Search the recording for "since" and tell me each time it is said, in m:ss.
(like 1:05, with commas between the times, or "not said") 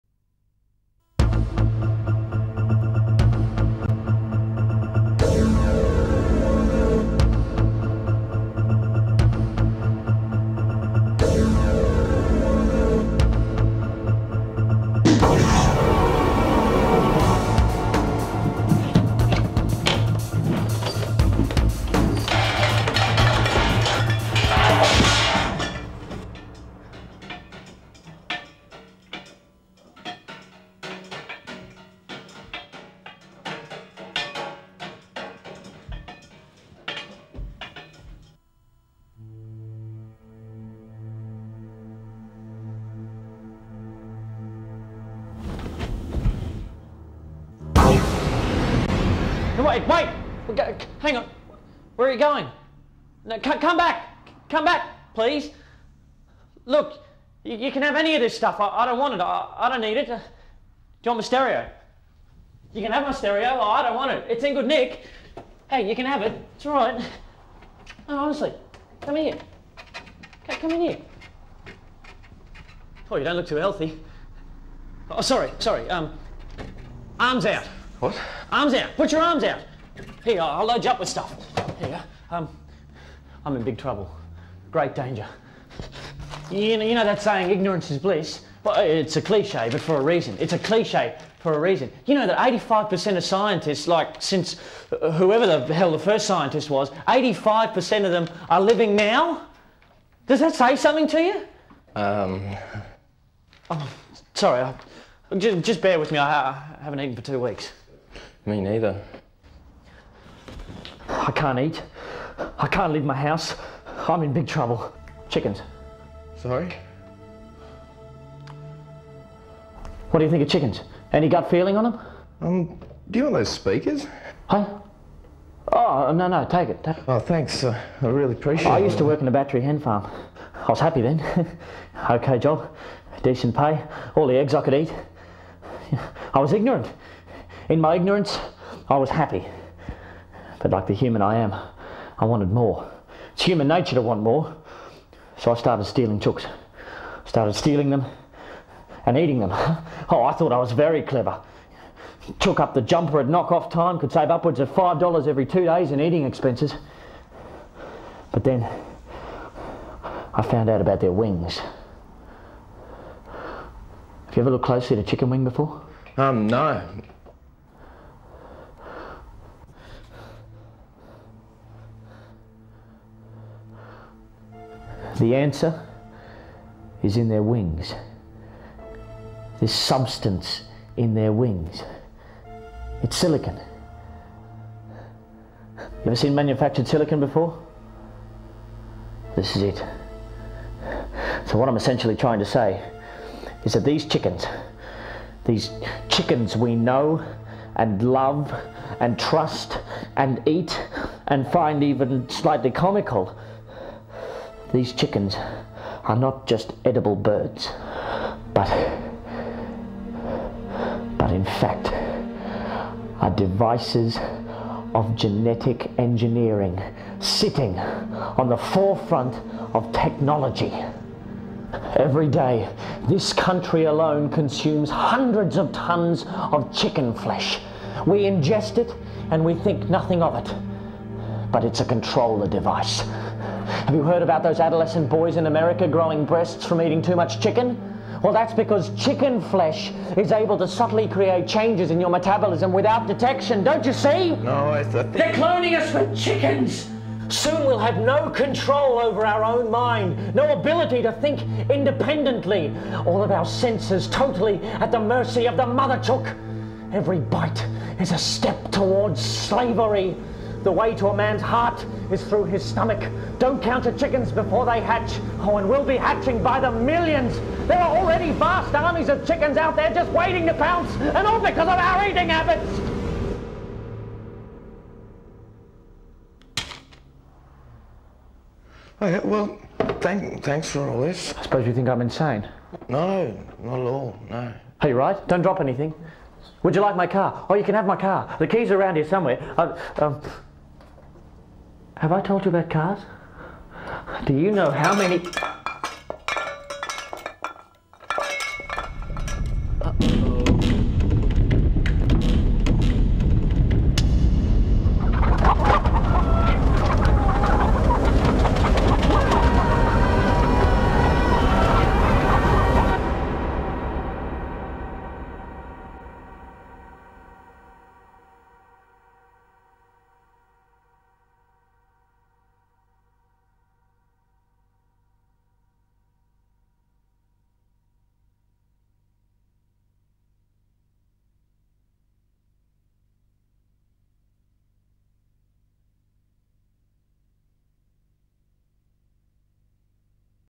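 1:34.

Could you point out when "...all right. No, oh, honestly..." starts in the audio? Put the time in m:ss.
1:06.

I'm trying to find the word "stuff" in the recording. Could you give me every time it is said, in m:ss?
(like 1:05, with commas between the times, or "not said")
0:58, 1:21.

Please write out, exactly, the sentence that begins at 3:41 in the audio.
Every day, this country alone consumes hundreds of tons of chicken flesh.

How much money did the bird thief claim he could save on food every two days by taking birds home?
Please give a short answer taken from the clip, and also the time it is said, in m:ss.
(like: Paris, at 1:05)
$5, at 2:34.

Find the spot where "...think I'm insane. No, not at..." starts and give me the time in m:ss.
4:41.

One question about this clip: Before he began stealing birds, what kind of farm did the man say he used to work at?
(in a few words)
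battery hen farm.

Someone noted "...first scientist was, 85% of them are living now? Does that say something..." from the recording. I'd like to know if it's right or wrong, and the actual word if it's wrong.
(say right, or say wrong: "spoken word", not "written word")
right.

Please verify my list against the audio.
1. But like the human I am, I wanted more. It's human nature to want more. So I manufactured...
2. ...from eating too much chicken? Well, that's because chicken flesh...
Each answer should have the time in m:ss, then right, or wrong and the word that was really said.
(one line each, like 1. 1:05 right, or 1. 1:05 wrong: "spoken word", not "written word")
1. 2:20 wrong: "started", not "manufactured"
2. 3:56 right.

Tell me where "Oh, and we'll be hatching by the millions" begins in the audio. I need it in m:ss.
4:25.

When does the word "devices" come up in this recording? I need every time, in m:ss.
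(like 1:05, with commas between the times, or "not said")
3:33, 3:52.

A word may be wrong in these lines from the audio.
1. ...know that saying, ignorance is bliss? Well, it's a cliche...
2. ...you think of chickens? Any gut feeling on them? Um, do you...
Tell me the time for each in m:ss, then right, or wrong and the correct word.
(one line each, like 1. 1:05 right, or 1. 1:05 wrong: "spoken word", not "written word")
1. 1:26 right
2. 2:00 right.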